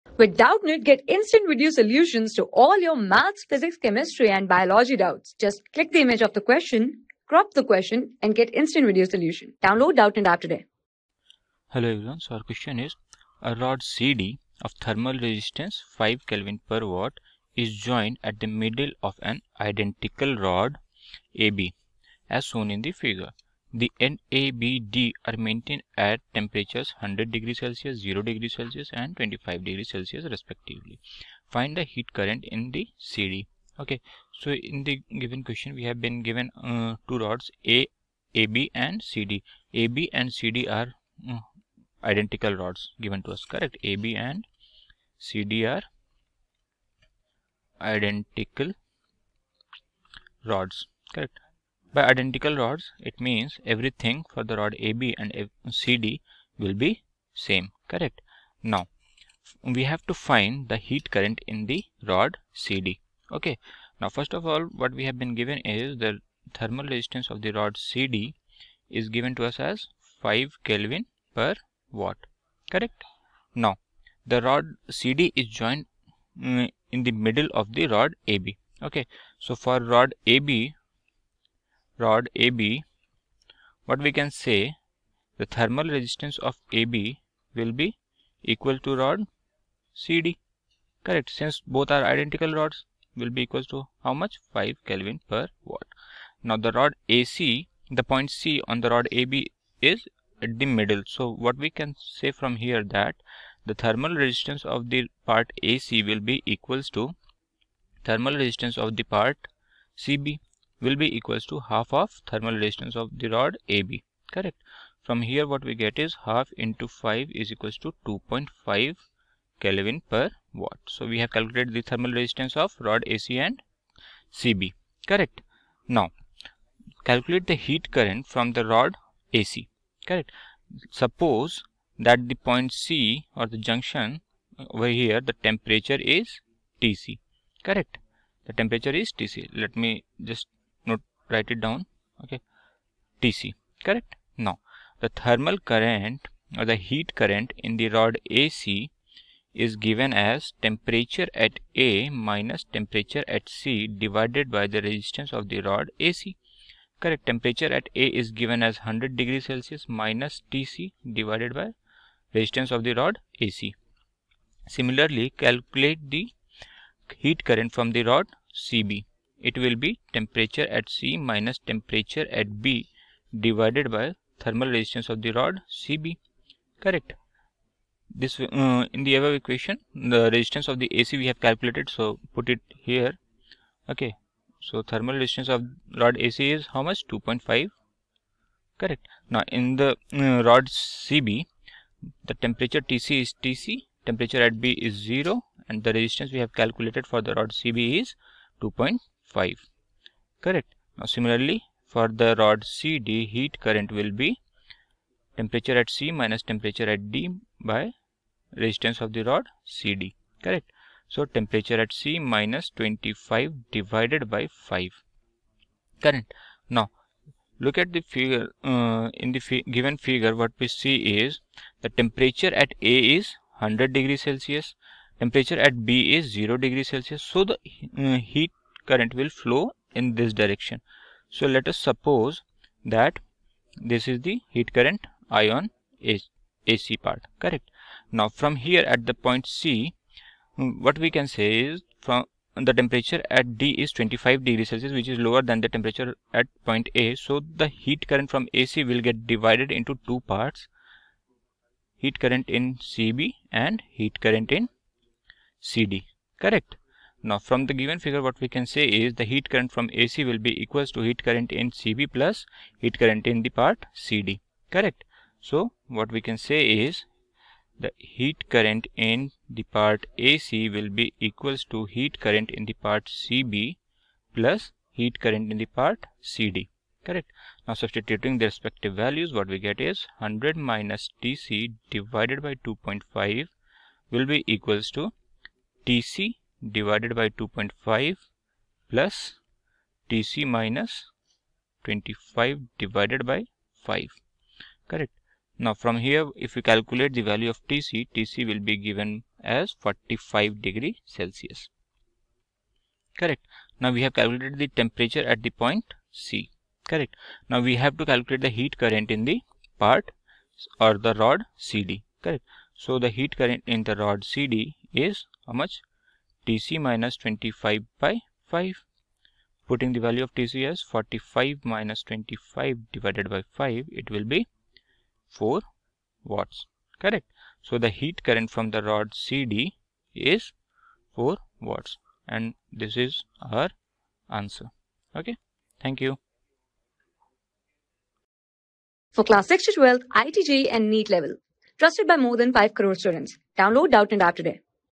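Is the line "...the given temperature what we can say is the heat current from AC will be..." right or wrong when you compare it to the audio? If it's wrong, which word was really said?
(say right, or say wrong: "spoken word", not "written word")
wrong: "figure", not "temperature".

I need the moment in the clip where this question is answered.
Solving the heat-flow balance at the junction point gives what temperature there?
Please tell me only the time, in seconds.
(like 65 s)
299 s.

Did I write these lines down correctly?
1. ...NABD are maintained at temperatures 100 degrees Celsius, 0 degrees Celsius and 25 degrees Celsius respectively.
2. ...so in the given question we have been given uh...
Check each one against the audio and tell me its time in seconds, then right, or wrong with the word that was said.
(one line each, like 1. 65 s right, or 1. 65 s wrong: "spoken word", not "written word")
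1. 24 s right
2. 34 s right.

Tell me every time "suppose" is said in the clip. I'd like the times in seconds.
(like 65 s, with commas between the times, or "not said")
130 s, 231 s.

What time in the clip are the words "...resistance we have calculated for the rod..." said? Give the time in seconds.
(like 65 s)
195 s.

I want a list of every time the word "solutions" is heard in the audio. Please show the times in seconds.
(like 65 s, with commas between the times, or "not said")
1 s, 9 s.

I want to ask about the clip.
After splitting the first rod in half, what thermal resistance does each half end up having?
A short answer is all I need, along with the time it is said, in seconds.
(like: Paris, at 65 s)
2.5 Kelvin per watt, at 118 s.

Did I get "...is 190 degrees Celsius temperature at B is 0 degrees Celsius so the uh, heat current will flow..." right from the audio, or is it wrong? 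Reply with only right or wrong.
wrong.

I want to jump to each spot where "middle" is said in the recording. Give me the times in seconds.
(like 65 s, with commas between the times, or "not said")
18 s, 77 s, 100 s.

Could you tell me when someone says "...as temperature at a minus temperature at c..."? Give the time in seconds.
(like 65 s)
150 s.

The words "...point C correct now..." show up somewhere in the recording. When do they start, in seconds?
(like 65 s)
305 s.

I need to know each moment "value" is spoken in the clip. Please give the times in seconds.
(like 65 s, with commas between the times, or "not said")
278 s, 297 s, 320 s.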